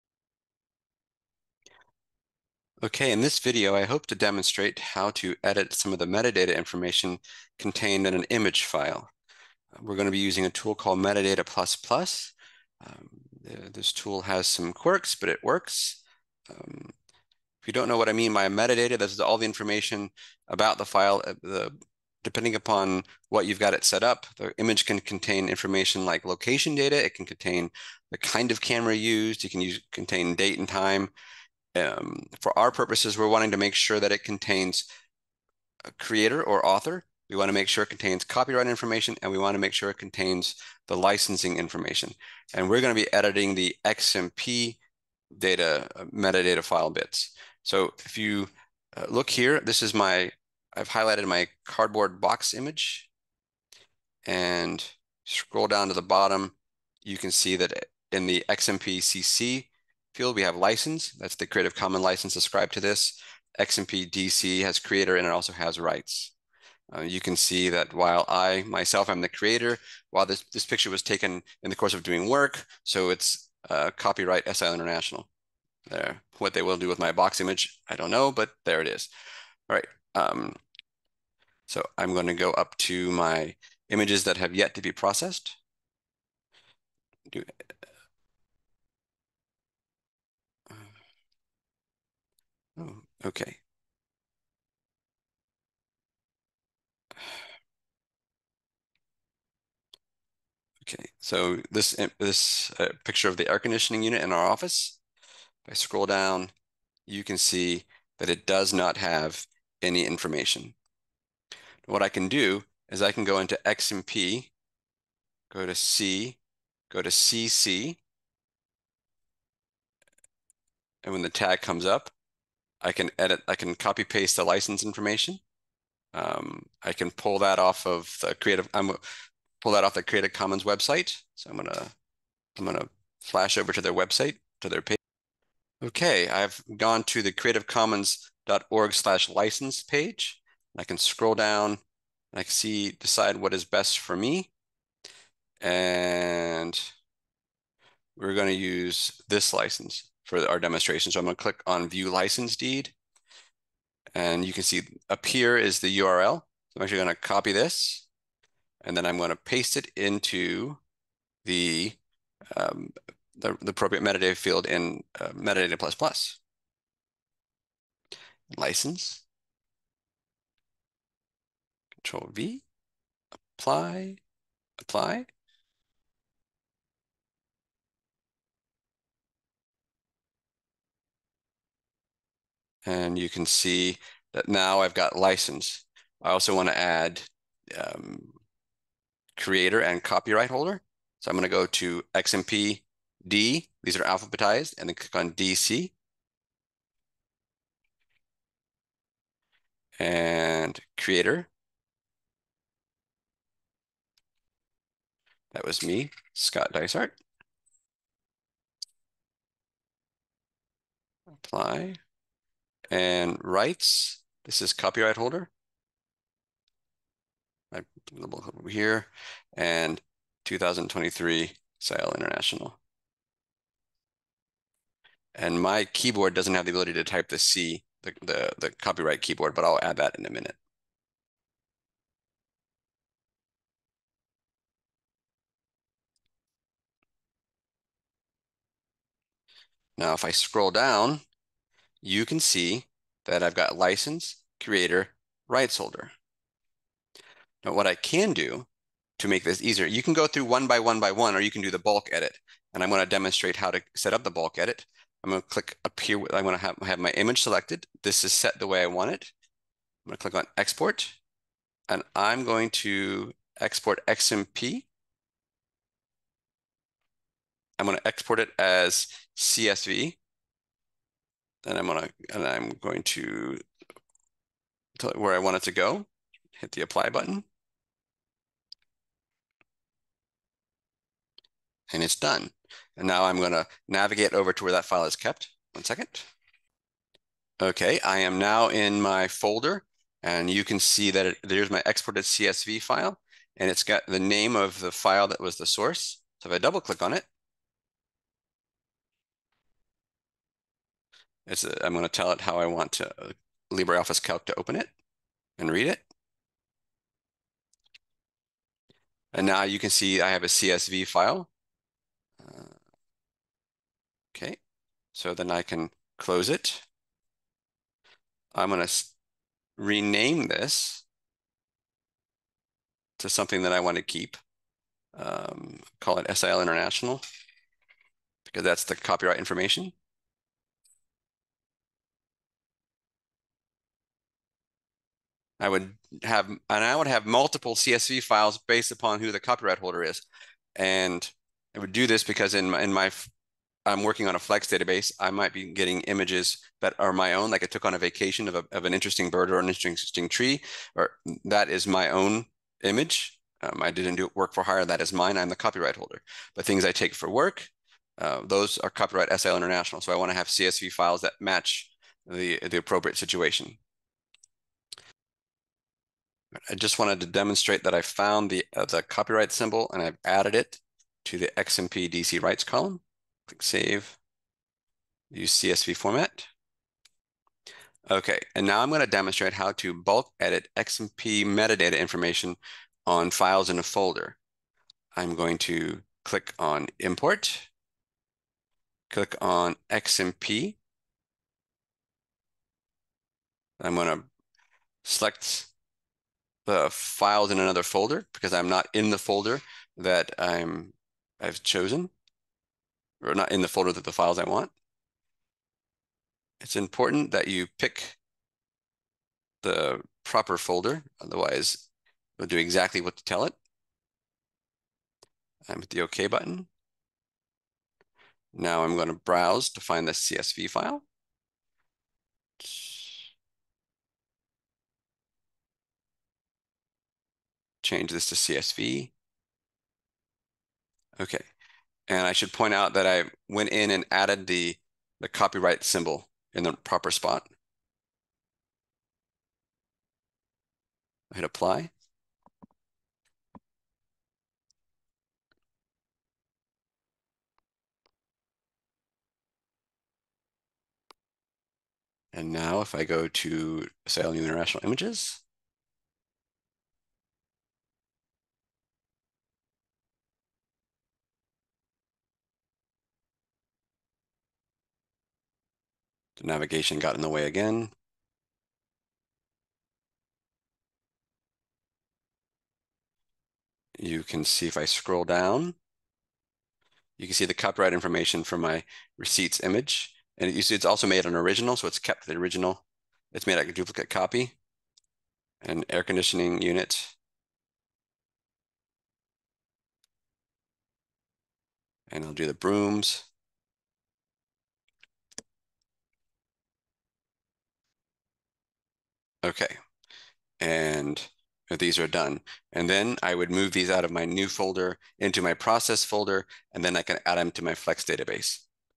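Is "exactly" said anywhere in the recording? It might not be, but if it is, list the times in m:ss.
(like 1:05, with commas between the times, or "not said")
6:52.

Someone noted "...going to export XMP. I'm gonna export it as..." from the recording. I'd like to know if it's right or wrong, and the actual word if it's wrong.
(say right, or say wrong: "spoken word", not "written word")
right.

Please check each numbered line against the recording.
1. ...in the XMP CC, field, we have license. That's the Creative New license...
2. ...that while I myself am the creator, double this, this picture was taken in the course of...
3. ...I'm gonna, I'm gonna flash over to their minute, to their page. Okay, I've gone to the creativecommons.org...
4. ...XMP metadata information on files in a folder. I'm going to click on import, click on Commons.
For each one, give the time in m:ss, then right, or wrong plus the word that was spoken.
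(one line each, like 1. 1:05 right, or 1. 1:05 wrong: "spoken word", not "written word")
1. 0:58 wrong: "Commons", not "New"
2. 1:07 wrong: "while", not "double"
3. 2:11 wrong: "website", not "minute"
4. 6:20 wrong: "XMP", not "Commons".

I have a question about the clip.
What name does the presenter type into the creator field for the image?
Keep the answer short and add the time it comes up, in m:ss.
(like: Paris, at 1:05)
Scott Dysart, at 3:26.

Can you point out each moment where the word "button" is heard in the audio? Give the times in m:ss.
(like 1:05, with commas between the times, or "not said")
4:37, 6:56.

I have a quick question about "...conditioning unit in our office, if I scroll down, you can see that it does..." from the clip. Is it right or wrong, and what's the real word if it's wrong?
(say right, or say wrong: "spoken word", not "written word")
right.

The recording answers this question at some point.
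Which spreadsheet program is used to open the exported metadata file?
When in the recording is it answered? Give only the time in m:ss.
5:03.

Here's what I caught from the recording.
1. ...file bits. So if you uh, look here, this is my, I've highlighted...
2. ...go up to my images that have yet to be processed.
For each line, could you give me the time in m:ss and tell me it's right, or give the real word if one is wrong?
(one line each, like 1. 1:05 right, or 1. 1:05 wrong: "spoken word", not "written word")
1. 0:46 right
2. 1:22 right.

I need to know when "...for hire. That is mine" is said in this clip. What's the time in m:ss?
5:54.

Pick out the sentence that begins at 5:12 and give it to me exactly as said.
Uh, okay, so then I can close it.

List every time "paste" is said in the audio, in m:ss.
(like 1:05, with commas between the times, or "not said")
2:04, 2:39.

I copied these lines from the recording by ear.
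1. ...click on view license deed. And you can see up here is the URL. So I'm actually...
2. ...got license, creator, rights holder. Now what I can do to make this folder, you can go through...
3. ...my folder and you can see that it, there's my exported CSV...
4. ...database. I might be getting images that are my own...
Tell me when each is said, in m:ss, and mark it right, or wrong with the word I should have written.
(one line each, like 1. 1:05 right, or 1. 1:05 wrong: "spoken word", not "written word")
1. 2:31 right
2. 4:03 wrong: "easier", not "folder"
3. 4:49 right
4. 5:44 right.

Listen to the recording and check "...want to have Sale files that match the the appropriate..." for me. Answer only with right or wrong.
wrong.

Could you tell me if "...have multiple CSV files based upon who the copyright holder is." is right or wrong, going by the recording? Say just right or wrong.
right.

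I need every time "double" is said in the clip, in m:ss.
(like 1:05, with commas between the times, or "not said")
4:56.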